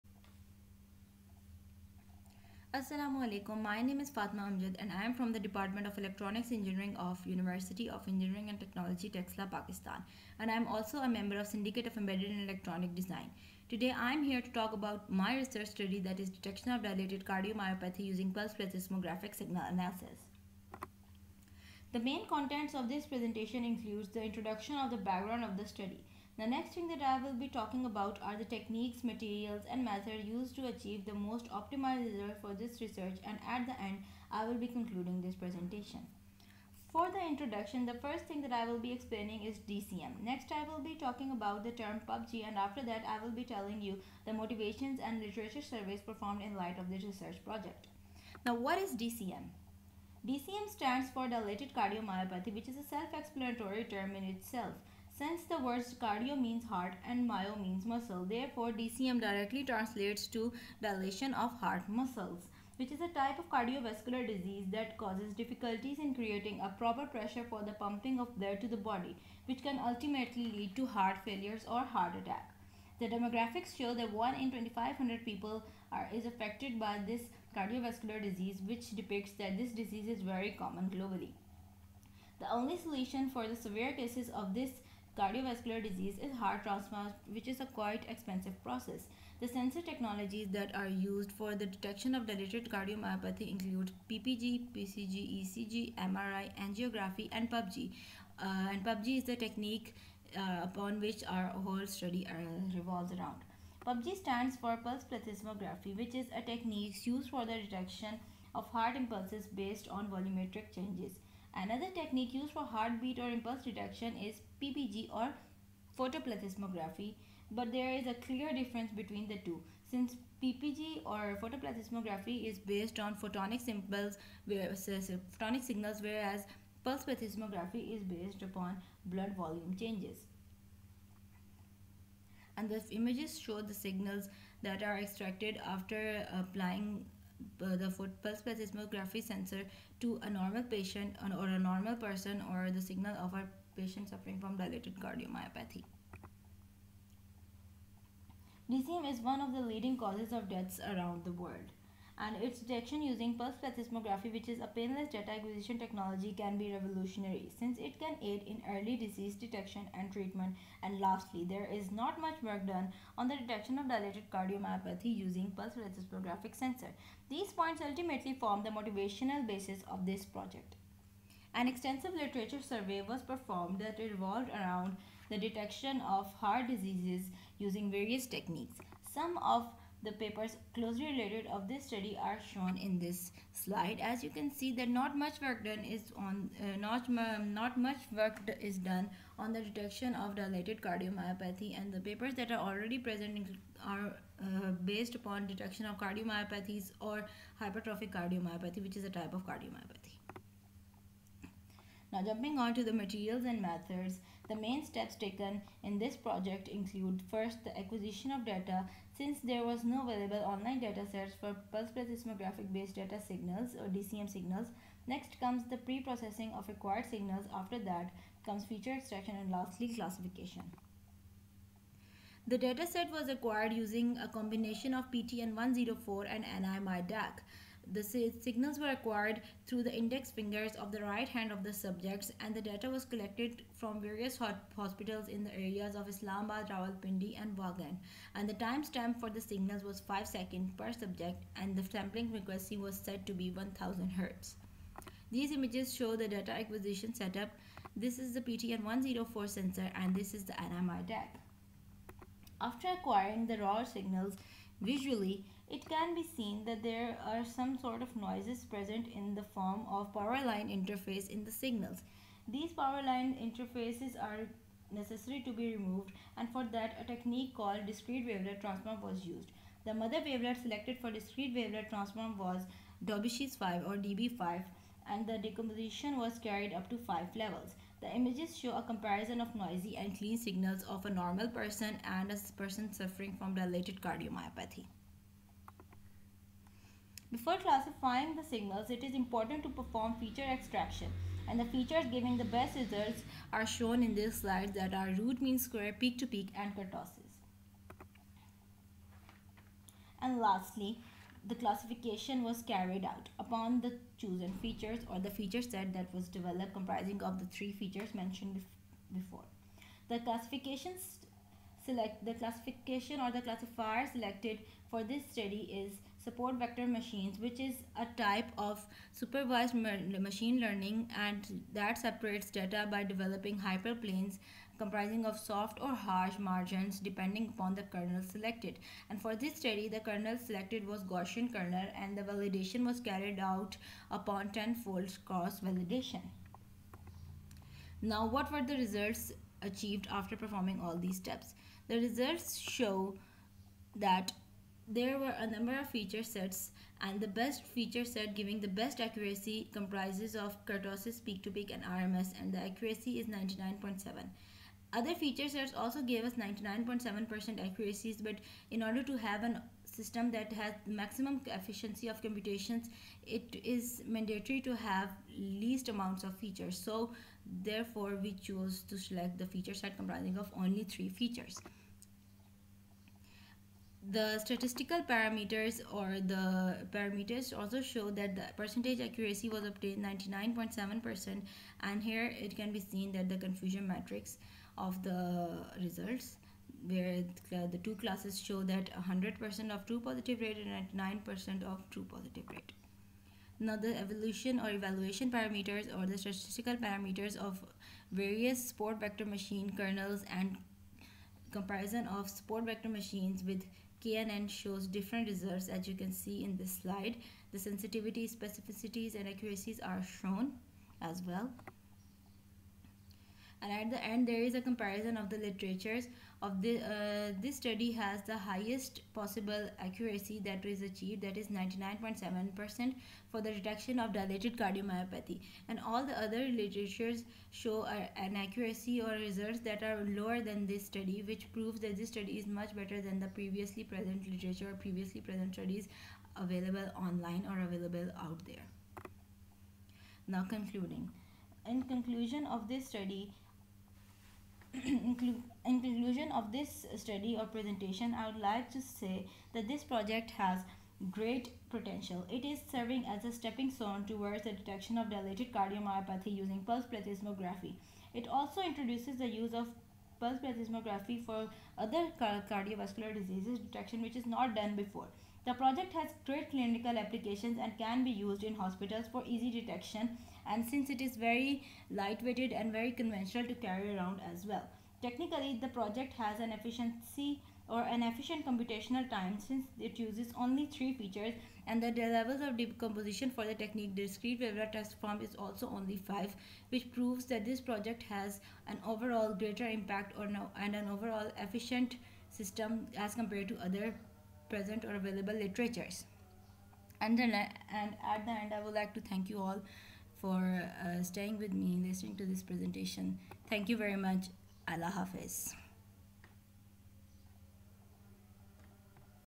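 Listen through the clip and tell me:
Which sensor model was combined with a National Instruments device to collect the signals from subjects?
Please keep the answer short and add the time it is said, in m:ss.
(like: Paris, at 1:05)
PTN 104, at 3:45.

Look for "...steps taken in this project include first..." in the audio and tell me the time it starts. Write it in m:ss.
3:24.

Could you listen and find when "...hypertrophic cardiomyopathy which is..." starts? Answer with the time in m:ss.
3:17.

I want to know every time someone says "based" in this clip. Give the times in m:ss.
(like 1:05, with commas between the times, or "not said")
1:49, 2:02, 2:08, 3:14, 3:32.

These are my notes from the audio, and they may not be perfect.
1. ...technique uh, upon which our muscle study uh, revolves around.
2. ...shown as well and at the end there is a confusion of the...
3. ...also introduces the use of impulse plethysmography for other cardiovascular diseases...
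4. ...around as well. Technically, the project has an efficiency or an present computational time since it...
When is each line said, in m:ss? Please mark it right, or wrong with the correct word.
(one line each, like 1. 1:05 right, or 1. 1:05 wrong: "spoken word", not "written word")
1. 1:39 wrong: "whole", not "muscle"
2. 6:50 wrong: "comparison", not "confusion"
3. 7:38 wrong: "pulse", not "impulse"
4. 7:53 wrong: "efficient", not "present".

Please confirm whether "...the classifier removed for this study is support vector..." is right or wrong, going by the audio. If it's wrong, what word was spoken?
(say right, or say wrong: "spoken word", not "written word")
wrong: "selected", not "removed".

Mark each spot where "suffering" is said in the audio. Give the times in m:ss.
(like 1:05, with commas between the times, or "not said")
2:24, 4:42.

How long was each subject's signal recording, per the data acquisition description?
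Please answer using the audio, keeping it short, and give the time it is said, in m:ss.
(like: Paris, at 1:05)
5 seconds, at 3:59.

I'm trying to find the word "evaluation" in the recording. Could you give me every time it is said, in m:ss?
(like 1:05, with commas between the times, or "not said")
6:34.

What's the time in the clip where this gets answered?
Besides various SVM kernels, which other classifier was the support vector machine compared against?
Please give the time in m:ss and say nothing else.
6:44.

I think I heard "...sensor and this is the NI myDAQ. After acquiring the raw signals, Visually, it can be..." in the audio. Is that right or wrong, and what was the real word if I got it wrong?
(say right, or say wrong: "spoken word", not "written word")
right.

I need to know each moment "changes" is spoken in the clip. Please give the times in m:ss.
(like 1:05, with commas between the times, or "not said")
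1:50, 2:09.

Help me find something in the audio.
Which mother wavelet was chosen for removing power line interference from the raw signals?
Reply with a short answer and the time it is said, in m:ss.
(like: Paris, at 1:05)
Daubechies 5, at 4:33.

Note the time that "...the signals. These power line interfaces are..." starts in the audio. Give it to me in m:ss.
4:21.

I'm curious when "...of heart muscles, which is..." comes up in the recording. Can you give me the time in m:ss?
1:01.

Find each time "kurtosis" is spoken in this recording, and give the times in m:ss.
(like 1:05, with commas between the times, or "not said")
4:56, 5:50.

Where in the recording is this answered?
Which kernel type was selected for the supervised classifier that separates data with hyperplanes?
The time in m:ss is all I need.
5:31.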